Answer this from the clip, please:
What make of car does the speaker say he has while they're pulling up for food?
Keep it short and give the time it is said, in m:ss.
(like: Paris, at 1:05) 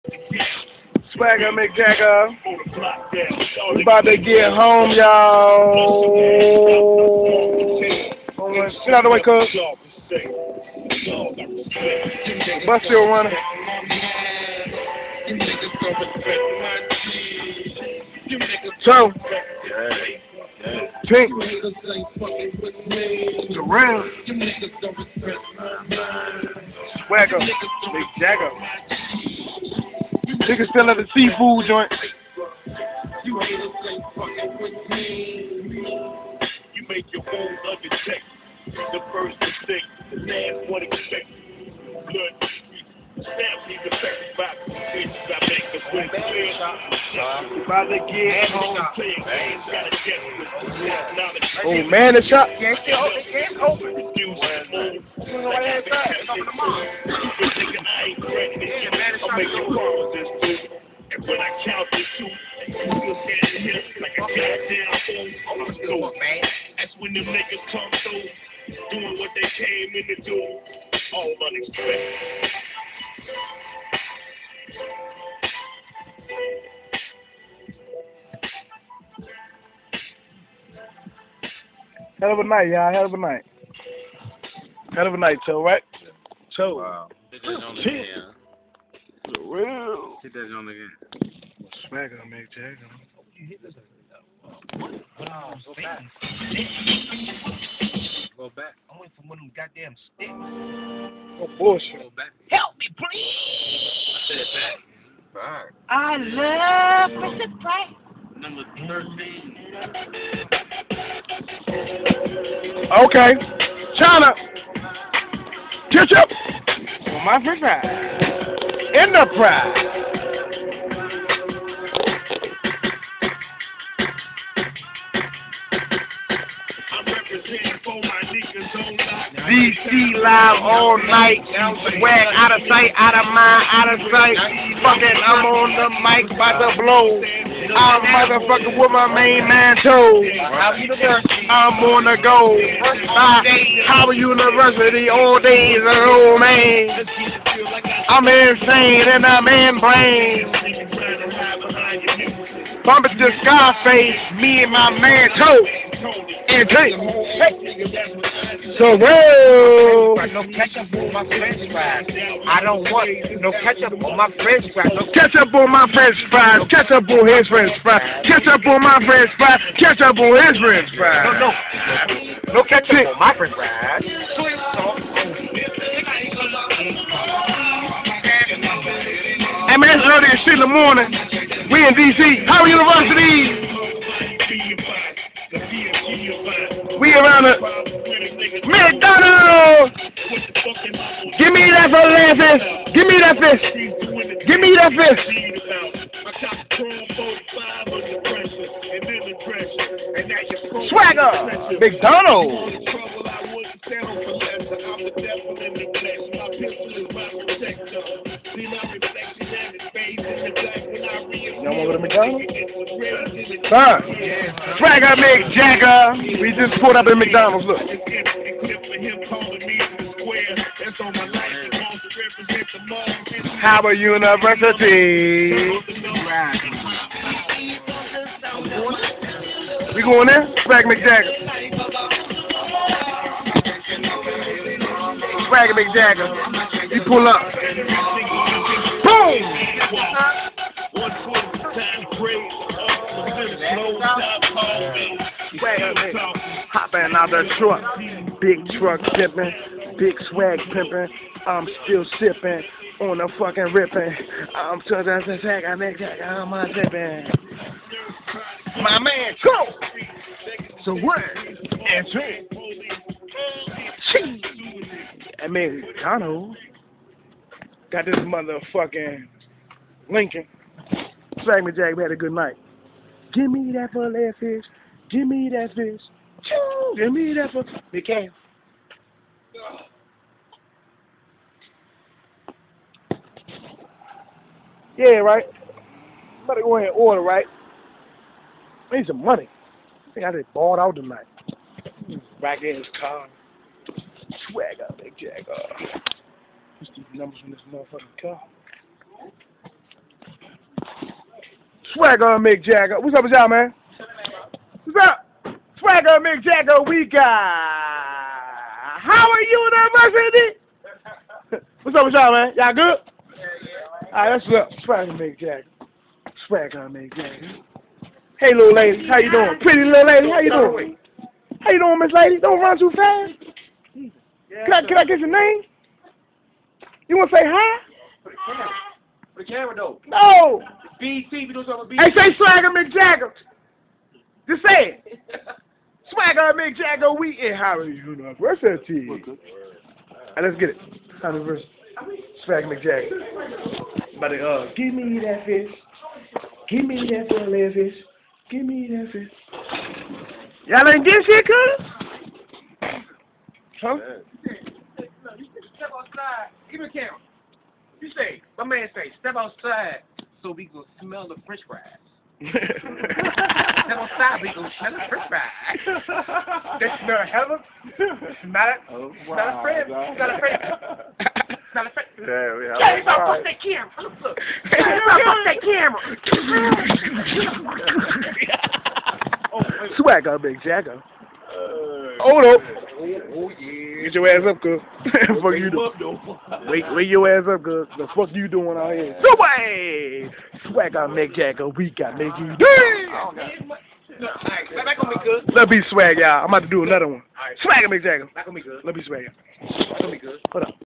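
Lincoln, at 4:30.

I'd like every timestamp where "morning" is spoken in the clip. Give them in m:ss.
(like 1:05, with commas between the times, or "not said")
3:00.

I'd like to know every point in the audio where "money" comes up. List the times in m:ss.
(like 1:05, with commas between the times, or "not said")
4:49.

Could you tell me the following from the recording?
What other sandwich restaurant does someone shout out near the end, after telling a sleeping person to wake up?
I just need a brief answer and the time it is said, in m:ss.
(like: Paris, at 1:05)
Subway, at 6:29.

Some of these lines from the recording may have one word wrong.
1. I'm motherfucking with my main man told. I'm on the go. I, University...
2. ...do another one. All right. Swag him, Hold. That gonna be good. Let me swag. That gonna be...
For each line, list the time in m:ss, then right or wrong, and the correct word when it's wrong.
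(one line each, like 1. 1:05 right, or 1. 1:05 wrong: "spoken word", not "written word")
1. 2:17 right
2. 6:36 wrong: "Jagger", not "Hold".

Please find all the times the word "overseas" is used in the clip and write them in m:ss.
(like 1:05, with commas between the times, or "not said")
not said.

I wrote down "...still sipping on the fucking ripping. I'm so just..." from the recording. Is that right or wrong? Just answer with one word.
right.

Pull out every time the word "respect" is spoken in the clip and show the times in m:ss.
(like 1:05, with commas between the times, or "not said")
not said.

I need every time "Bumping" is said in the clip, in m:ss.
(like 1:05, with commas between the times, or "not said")
2:32.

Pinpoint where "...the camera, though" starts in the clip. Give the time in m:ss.
5:29.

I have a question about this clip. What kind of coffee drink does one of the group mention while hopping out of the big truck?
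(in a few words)
Americano.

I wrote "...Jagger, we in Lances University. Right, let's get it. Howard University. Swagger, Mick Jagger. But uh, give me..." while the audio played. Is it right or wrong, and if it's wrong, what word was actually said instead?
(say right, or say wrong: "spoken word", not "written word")
wrong: "Howard", not "Lances".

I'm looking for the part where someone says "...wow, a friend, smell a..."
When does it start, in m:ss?
6:09.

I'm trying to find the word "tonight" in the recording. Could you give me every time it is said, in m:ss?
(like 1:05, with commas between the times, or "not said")
4:50.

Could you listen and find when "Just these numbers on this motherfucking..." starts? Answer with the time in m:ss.
4:56.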